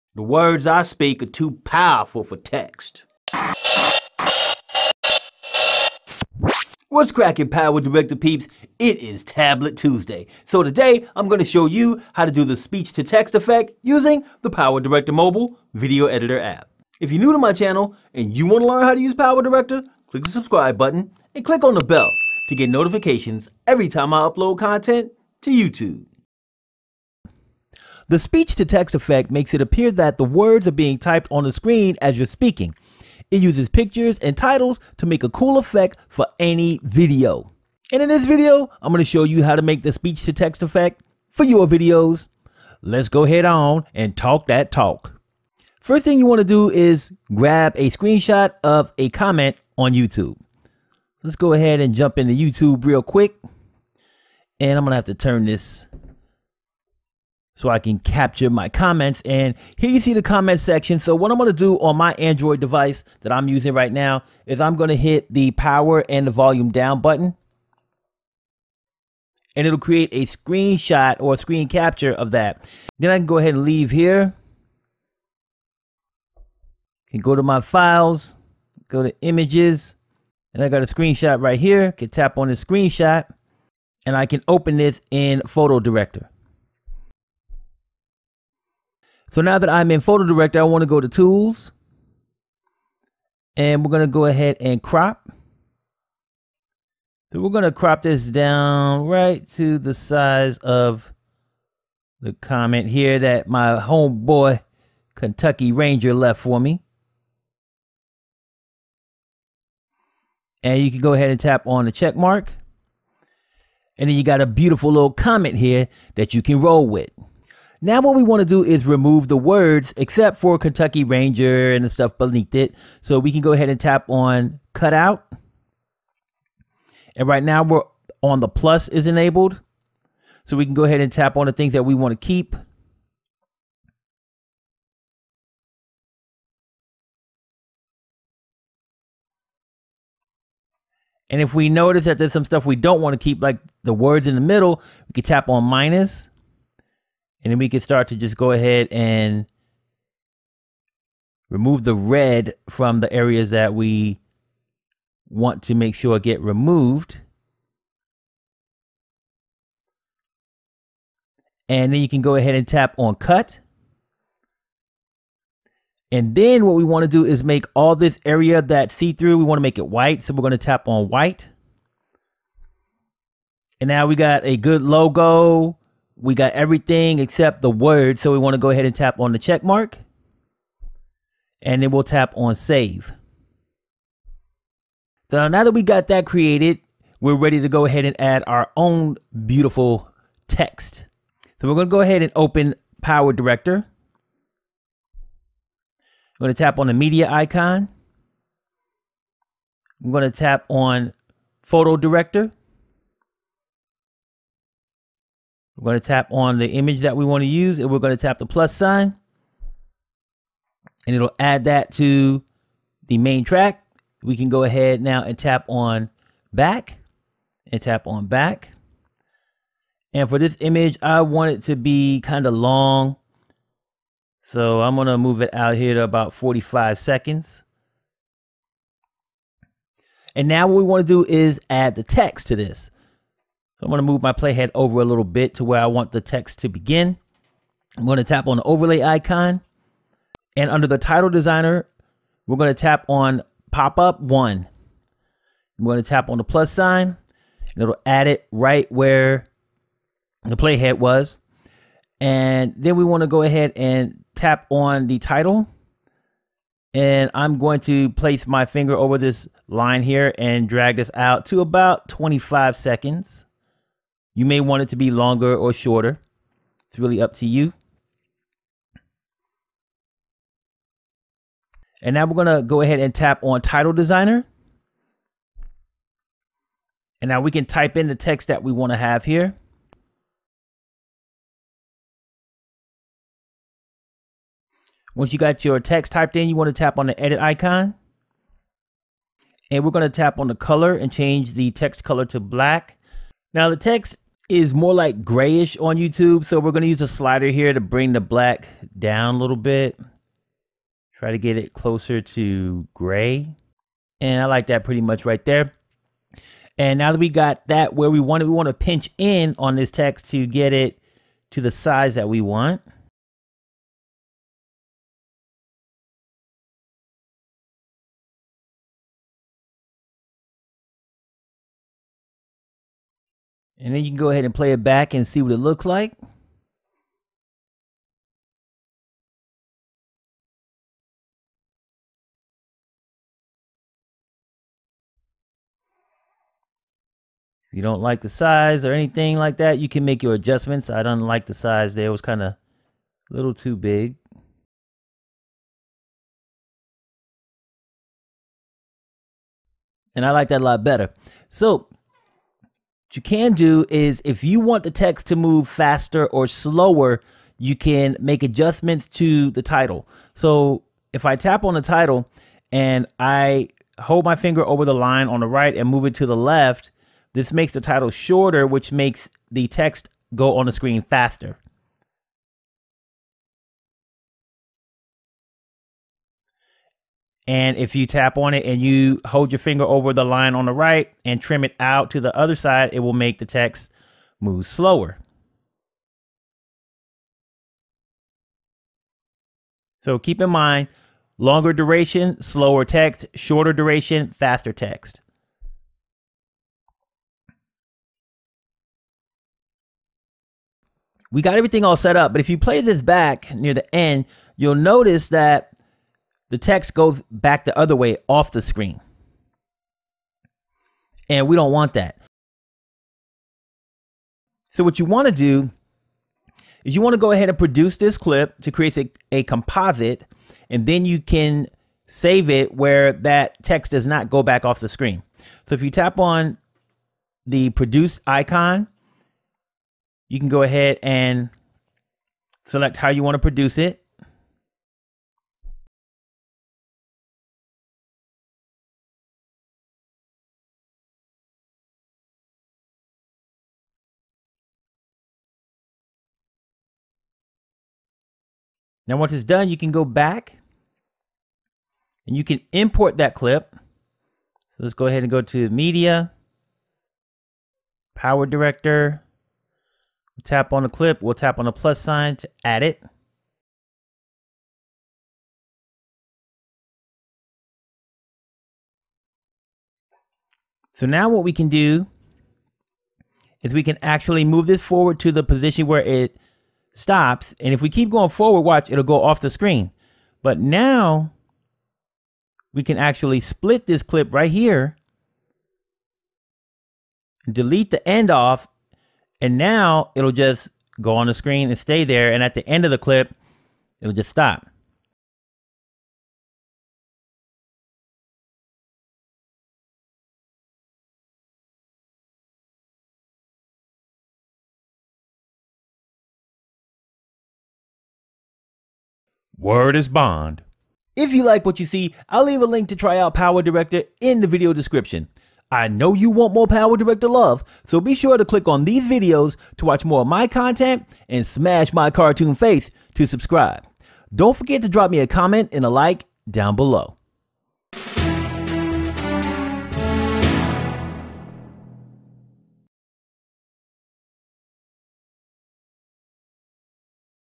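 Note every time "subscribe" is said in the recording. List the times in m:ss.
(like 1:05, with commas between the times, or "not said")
0:20, 8:43.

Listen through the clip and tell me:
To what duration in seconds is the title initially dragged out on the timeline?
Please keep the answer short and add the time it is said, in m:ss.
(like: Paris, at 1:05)
25, at 4:22.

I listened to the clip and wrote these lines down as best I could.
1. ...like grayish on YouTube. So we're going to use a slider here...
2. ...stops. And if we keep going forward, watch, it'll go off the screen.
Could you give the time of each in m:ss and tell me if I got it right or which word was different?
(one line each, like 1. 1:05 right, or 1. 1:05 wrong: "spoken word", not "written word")
1. 4:54 right
2. 7:56 right.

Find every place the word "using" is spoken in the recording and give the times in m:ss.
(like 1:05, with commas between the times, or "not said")
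0:13, 1:03.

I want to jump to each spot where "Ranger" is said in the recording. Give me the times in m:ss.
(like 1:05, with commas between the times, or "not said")
1:45, 2:01.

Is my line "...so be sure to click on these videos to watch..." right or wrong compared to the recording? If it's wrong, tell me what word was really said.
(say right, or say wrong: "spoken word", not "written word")
right.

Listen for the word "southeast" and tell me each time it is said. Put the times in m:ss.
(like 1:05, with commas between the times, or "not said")
not said.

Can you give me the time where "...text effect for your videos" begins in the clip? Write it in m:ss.
0:40.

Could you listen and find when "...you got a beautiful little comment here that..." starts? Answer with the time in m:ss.
1:54.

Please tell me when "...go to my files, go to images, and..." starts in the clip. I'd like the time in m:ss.
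1:17.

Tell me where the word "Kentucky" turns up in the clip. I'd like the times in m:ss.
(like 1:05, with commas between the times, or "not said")
1:45, 2:00.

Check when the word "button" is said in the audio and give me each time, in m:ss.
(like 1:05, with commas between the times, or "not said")
0:20, 1:07.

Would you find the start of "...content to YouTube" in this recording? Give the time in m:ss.
0:24.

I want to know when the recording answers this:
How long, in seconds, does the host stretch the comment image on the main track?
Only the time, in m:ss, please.
3:46.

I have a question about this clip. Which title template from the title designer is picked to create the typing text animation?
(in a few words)
pop up one.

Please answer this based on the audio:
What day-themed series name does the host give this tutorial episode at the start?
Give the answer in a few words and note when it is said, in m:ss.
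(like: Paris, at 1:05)
Tablet Tuesday, at 0:09.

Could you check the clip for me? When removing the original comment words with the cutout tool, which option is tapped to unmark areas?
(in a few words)
minus.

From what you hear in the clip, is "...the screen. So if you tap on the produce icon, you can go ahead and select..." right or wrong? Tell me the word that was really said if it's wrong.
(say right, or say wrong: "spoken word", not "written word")
right.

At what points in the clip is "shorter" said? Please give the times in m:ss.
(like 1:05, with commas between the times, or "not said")
4:25, 6:08, 6:33.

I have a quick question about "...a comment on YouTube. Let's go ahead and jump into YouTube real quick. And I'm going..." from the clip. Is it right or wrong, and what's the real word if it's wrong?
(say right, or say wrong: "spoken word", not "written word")
right.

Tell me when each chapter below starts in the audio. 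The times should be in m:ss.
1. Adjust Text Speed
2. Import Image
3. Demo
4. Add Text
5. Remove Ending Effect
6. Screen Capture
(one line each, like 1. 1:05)
1. 5:55
2. 3:05
3. 0:27
4. 3:50
5. 6:40
6. 0:45.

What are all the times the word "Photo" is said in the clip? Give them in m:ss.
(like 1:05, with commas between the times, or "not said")
1:25, 1:30, 3:21.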